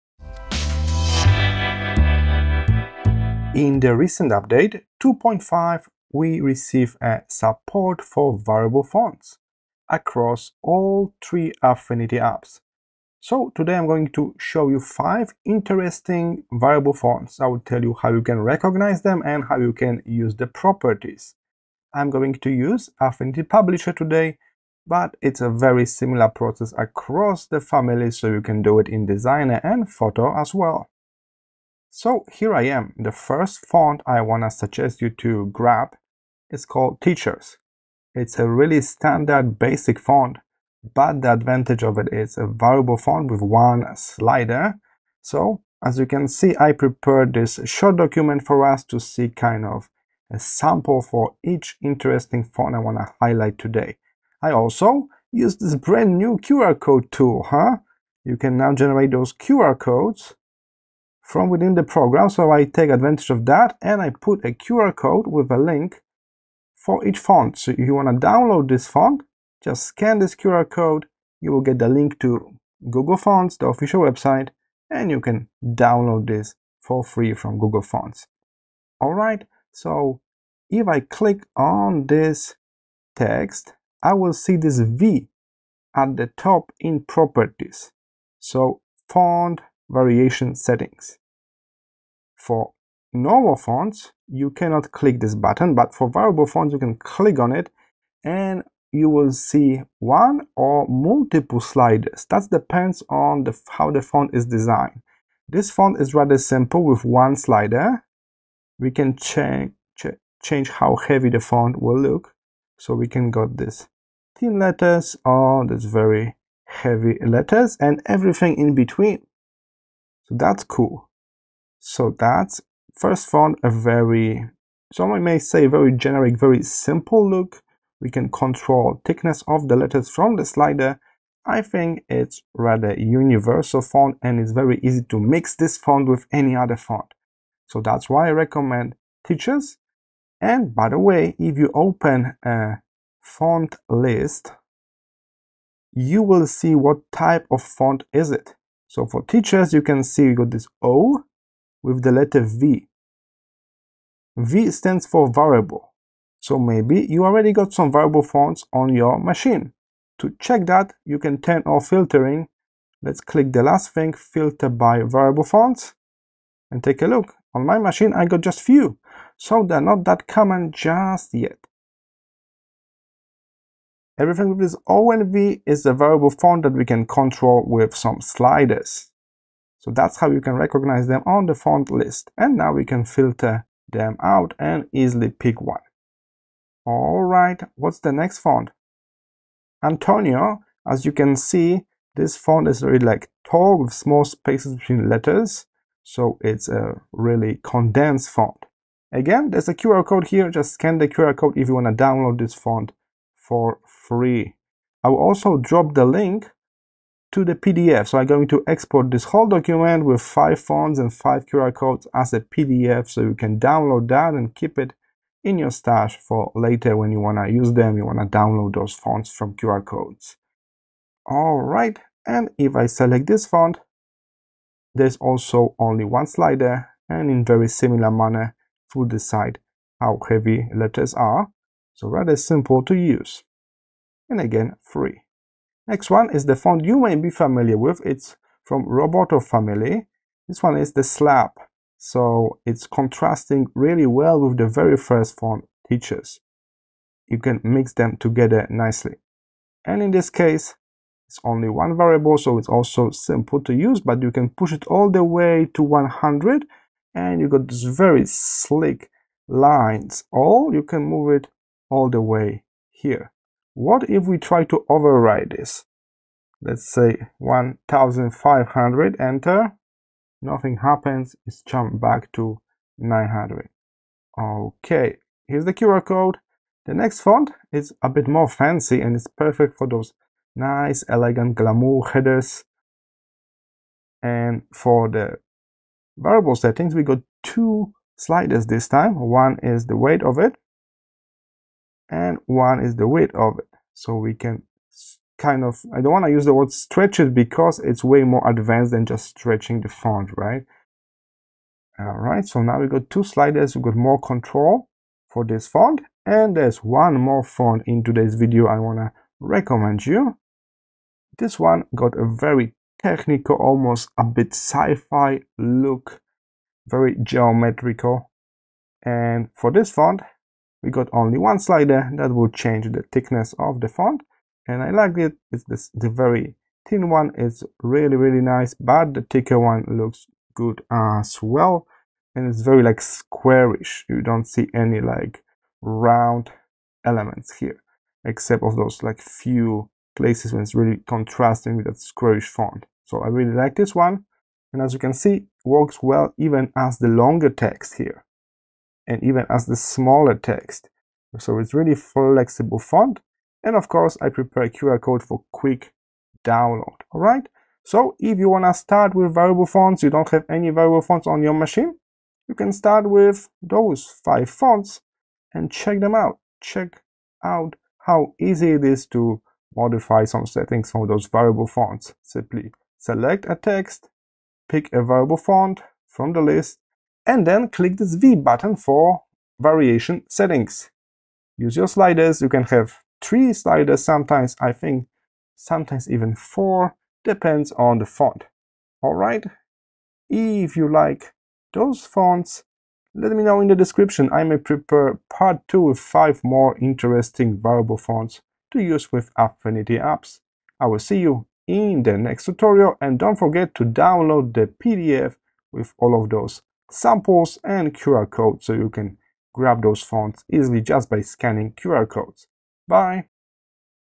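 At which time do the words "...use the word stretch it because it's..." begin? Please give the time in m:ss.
4:56.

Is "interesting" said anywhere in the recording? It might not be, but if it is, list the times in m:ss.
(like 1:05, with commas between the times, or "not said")
0:15, 0:51, 6:36.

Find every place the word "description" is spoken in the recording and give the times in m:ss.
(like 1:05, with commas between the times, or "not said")
6:33.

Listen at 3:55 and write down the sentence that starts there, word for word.
Next one is the font you may be familiar with.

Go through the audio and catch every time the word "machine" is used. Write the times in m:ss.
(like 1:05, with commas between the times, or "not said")
2:39, 2:47, 6:01.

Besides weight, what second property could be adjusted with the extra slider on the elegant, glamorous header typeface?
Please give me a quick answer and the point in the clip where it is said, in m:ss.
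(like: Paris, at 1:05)
width, at 4:53.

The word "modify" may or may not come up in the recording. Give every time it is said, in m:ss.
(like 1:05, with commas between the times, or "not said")
6:09.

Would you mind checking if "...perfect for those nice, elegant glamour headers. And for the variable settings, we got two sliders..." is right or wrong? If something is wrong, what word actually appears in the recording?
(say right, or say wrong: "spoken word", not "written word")
right.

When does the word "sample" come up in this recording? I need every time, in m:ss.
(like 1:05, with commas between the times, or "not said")
0:50, 6:46.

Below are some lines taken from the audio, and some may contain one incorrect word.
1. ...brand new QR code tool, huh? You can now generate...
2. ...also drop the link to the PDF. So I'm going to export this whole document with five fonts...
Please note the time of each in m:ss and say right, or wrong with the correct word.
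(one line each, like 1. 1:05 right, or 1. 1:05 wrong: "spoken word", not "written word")
1. 0:55 right
2. 3:25 right.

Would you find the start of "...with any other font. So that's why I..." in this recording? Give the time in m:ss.
2:16.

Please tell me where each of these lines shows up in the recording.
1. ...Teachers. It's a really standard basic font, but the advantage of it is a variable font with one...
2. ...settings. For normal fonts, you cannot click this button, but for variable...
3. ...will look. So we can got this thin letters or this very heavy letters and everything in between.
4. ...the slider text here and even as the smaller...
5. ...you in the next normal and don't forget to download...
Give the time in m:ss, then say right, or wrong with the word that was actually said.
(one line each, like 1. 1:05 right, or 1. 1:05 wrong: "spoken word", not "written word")
1. 0:37 right
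2. 1:30 right
3. 1:51 right
4. 5:46 wrong: "longer", not "slider"
5. 6:41 wrong: "tutorial", not "normal".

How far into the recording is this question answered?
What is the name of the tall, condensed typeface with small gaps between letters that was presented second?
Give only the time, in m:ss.
3:09.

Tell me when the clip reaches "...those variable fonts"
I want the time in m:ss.
6:11.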